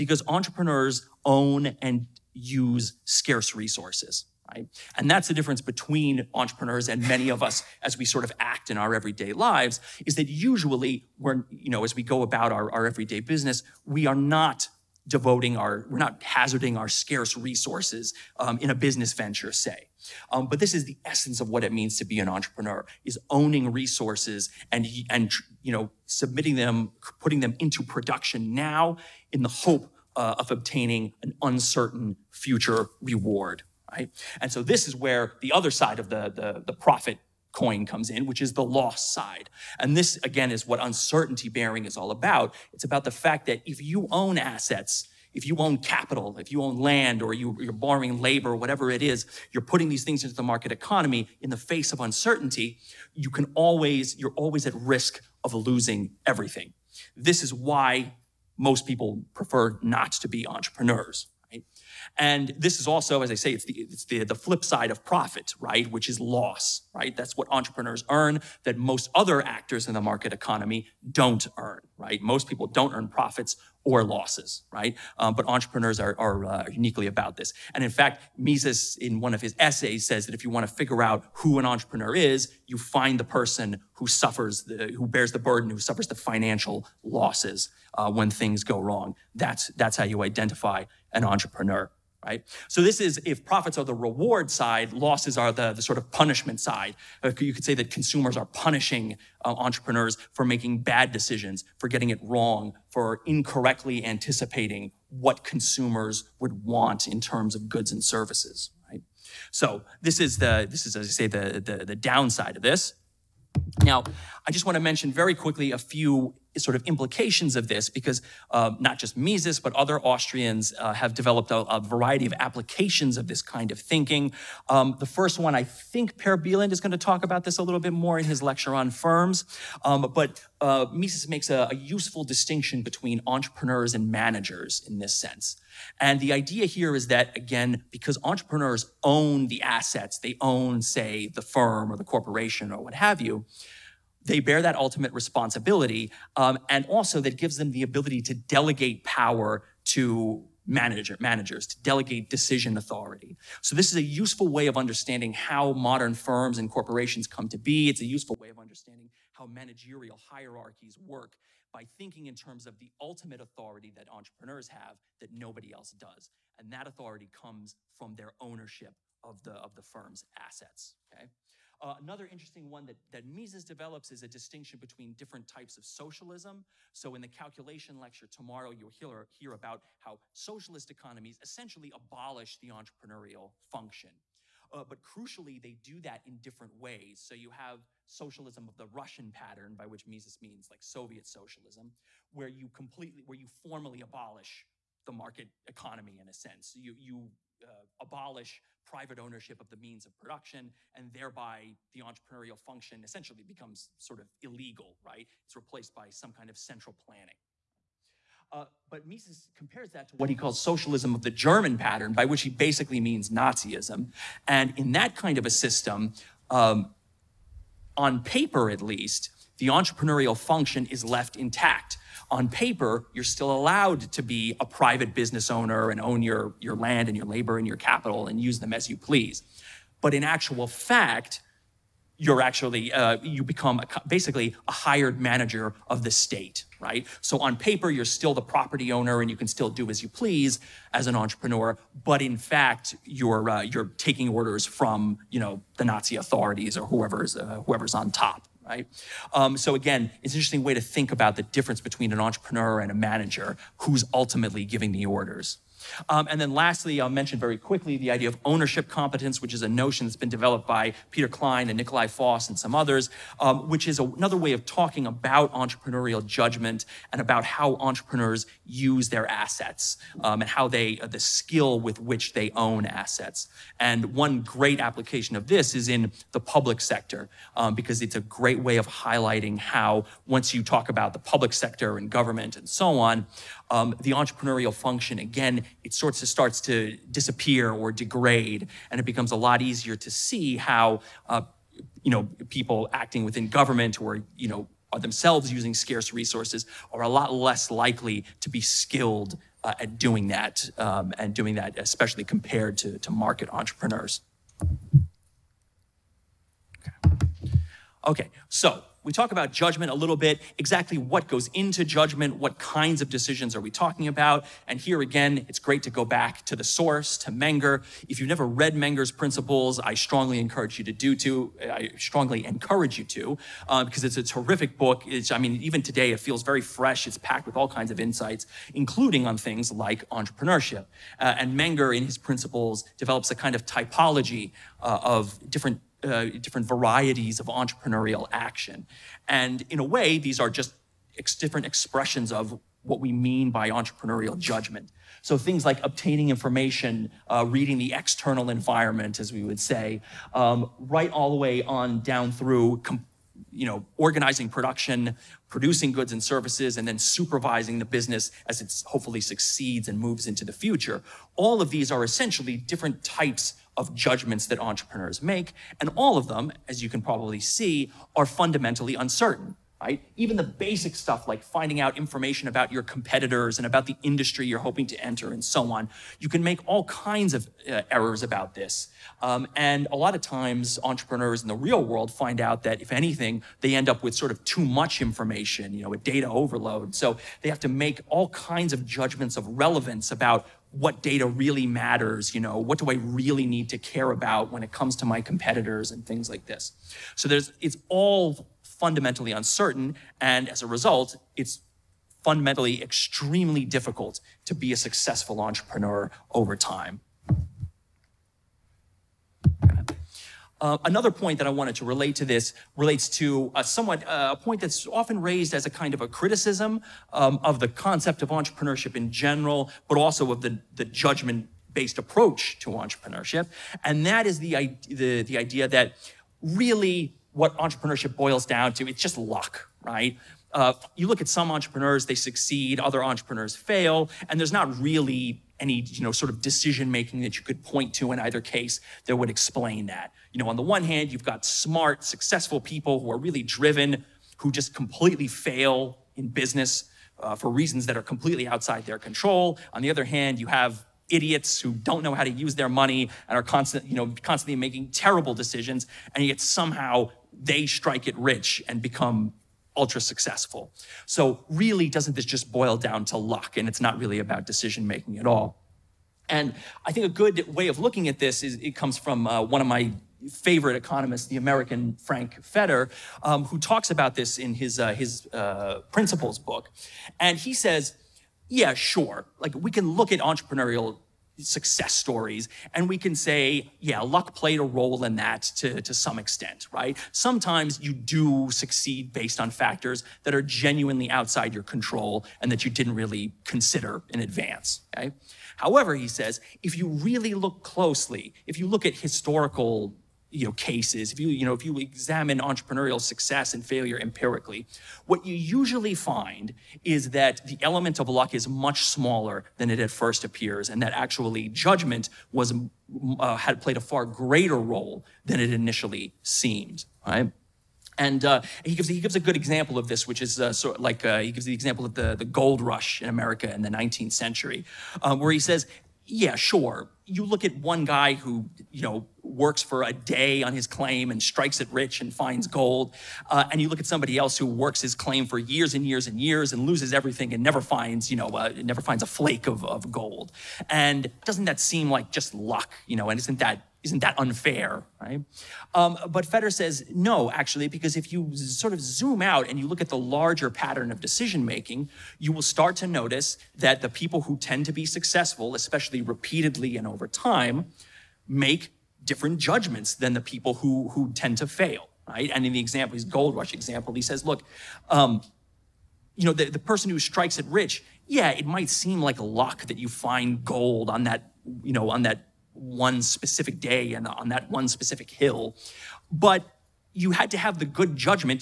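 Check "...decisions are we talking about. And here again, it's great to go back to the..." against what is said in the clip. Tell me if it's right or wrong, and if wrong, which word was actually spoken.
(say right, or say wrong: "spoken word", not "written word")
right.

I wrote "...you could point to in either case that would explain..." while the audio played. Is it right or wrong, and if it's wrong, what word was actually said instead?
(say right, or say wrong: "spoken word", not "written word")
right.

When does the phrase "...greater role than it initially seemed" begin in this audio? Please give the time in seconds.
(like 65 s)
514 s.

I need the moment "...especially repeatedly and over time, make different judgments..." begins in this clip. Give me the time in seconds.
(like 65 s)
555 s.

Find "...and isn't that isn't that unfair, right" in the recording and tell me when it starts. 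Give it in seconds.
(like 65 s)
543 s.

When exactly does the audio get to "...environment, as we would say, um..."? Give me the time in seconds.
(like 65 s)
348 s.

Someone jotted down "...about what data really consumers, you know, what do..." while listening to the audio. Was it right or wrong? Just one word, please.
wrong.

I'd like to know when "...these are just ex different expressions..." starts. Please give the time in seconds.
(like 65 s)
340 s.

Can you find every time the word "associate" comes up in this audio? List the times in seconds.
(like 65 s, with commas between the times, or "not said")
not said.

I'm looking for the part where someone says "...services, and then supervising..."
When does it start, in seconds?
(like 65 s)
356 s.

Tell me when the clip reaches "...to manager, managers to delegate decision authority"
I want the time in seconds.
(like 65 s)
149 s.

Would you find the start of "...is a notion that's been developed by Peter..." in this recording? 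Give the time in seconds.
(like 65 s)
259 s.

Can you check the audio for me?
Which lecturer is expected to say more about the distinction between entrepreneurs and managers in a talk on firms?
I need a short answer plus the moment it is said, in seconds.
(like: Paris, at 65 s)
Per Bylund, at 126 s.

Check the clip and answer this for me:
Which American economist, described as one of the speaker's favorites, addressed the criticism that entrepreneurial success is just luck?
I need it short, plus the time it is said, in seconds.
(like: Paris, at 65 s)
Frank Fetter, at 471 s.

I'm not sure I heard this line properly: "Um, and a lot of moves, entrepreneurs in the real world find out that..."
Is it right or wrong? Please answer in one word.
wrong.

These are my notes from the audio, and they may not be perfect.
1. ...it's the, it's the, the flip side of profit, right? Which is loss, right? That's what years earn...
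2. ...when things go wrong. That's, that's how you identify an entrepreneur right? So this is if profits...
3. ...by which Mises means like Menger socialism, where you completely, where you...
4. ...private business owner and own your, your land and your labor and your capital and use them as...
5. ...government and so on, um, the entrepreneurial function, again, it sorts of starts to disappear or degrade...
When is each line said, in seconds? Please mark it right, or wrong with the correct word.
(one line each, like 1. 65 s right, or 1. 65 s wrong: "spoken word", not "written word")
1. 63 s wrong: "entrepreneurs", not "years"
2. 88 s right
3. 189 s wrong: "Soviet", not "Menger"
4. 224 s right
5. 282 s right.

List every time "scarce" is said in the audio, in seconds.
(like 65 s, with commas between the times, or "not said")
3 s, 16 s, 295 s.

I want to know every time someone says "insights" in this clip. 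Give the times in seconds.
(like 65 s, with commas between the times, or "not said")
327 s.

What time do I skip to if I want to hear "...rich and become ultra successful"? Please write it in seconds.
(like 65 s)
458 s.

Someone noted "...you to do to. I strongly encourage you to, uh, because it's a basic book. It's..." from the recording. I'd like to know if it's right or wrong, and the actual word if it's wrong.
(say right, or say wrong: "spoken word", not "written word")
wrong: "terrific", not "basic".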